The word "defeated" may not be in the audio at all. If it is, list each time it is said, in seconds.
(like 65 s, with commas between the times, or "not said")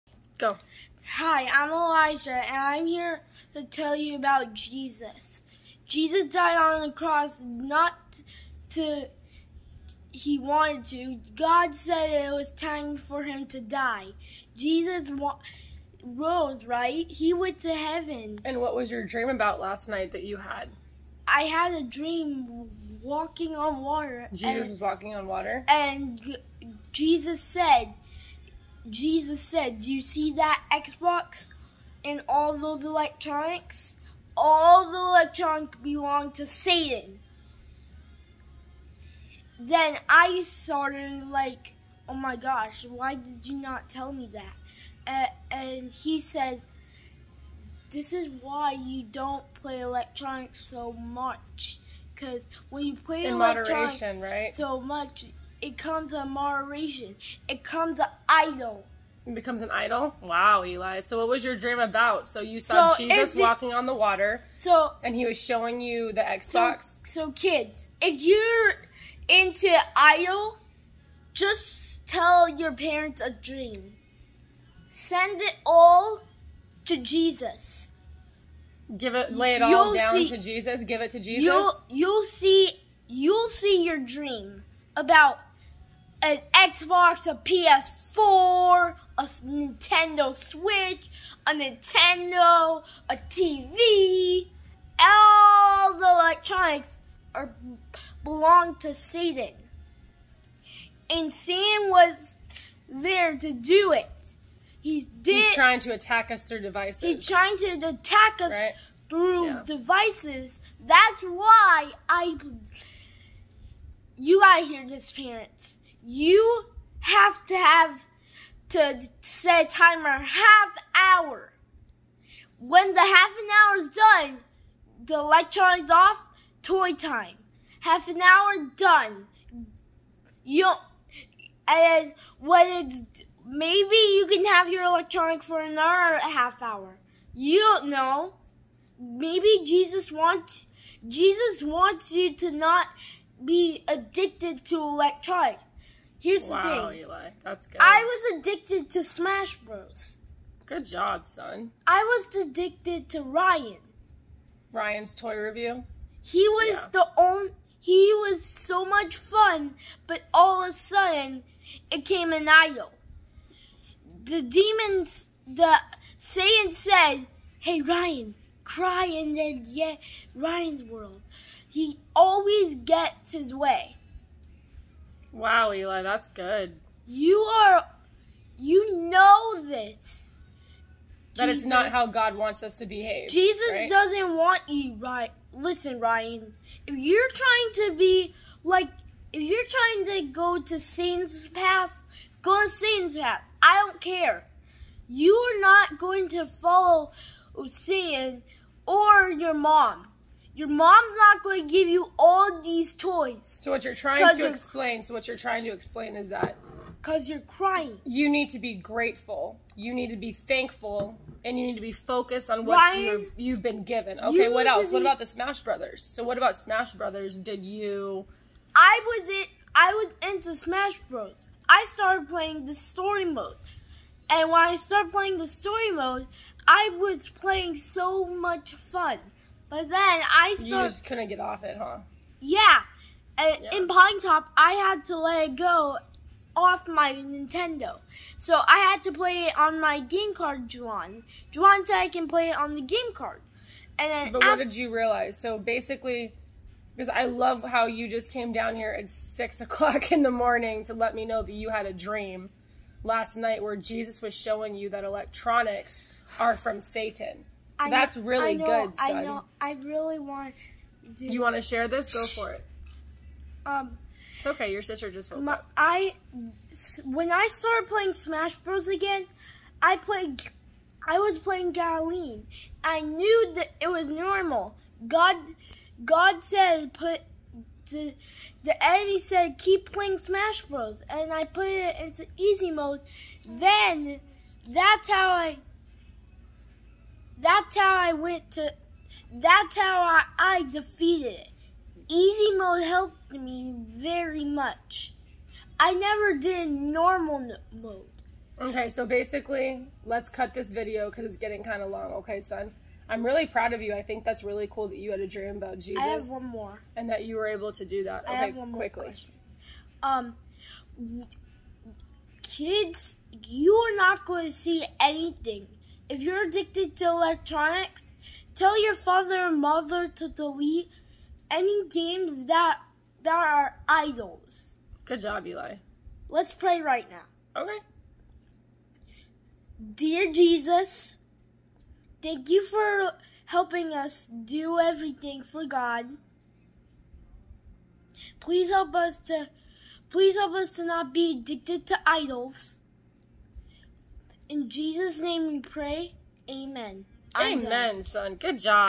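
290 s.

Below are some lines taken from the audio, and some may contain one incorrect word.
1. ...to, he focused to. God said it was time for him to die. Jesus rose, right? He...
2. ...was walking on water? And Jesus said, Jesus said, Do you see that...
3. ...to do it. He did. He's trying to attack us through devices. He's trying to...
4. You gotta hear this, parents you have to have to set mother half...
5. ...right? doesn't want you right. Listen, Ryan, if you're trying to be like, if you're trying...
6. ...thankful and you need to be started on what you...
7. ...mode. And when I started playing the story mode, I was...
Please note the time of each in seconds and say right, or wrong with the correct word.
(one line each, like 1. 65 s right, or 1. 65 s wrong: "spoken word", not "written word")
1. 8 s wrong: "wanted", not "focused"
2. 24 s right
3. 103 s right
4. 114 s wrong: "timer", not "mother"
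5. 183 s right
6. 210 s wrong: "focused", not "started"
7. 223 s right.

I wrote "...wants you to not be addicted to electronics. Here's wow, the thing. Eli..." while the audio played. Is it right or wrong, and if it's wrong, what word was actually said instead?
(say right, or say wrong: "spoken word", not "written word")
right.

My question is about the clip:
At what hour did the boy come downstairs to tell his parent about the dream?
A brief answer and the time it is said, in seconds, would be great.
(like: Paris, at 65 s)
6 o'clock, at 249 s.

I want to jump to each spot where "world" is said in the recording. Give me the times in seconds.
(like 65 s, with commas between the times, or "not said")
170 s.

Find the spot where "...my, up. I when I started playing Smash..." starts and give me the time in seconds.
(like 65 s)
265 s.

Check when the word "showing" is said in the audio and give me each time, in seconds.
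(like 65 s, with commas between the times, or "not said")
65 s, 254 s.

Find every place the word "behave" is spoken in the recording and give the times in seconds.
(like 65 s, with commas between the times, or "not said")
182 s.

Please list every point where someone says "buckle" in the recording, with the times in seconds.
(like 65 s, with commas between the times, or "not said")
not said.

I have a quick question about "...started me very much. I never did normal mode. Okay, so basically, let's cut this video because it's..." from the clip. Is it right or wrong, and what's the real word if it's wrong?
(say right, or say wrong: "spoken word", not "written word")
wrong: "helped", not "started".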